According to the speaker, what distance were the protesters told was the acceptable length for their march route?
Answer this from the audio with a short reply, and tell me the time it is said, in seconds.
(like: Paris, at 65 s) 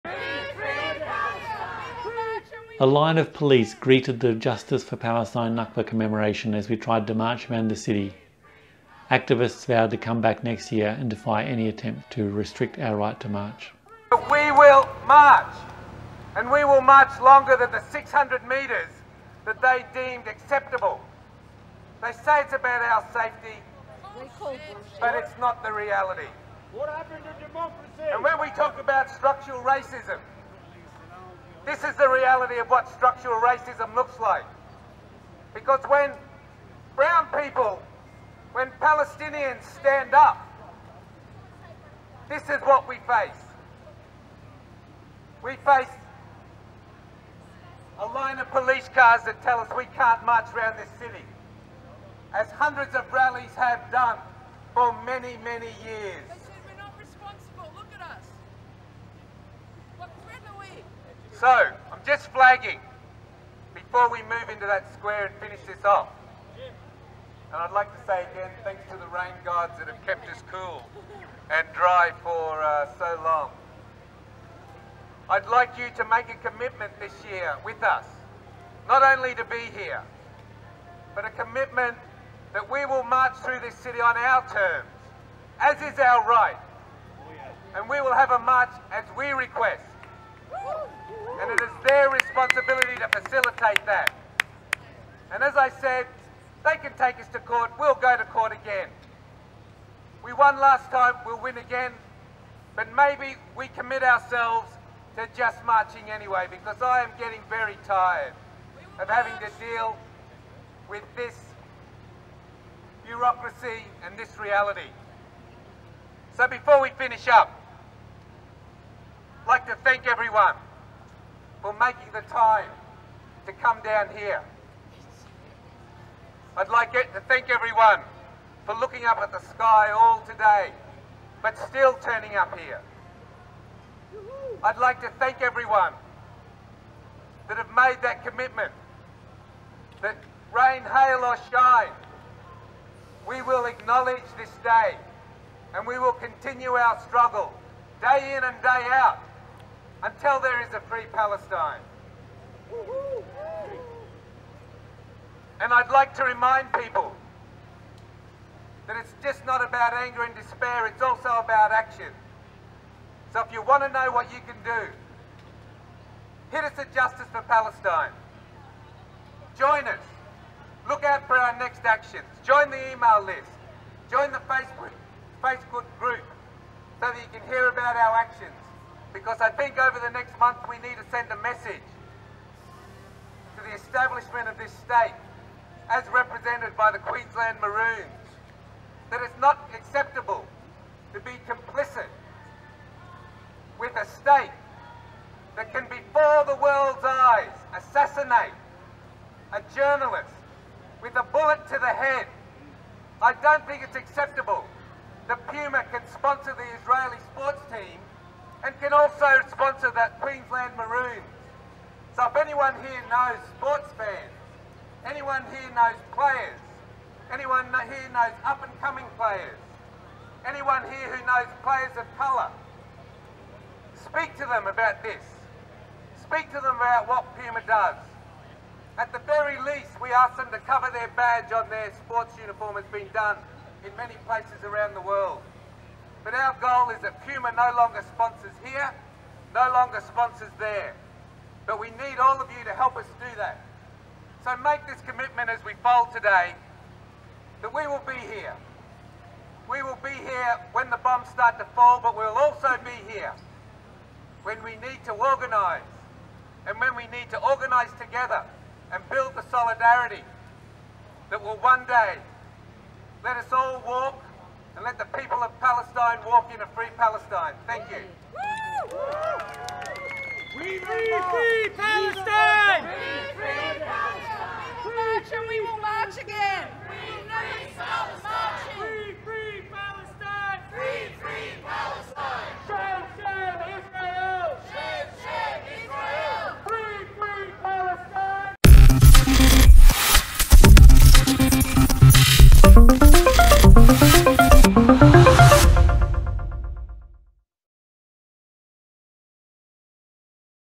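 600 metres, at 17 s.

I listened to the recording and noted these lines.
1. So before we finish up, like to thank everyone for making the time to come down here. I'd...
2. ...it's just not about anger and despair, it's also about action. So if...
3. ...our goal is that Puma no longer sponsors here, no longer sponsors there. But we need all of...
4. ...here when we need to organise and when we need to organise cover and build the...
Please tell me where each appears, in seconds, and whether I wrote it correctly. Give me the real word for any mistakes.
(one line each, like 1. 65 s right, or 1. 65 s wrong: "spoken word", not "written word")
1. 116 s right
2. 158 s right
3. 236 s right
4. 253 s wrong: "together", not "cover".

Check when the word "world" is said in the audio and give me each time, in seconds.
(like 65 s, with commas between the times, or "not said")
196 s, 235 s.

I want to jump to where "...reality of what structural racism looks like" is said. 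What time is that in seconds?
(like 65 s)
32 s.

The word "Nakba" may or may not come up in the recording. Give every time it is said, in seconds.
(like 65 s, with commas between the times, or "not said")
5 s.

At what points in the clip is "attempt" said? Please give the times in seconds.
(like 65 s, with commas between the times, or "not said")
11 s.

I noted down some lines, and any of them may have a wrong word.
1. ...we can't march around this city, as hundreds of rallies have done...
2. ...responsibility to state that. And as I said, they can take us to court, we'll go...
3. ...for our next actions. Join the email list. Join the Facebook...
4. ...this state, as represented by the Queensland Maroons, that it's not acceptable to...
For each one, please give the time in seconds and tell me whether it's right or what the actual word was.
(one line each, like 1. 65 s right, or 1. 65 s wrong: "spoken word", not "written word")
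1. 49 s right
2. 92 s wrong: "facilitate", not "state"
3. 171 s right
4. 184 s right.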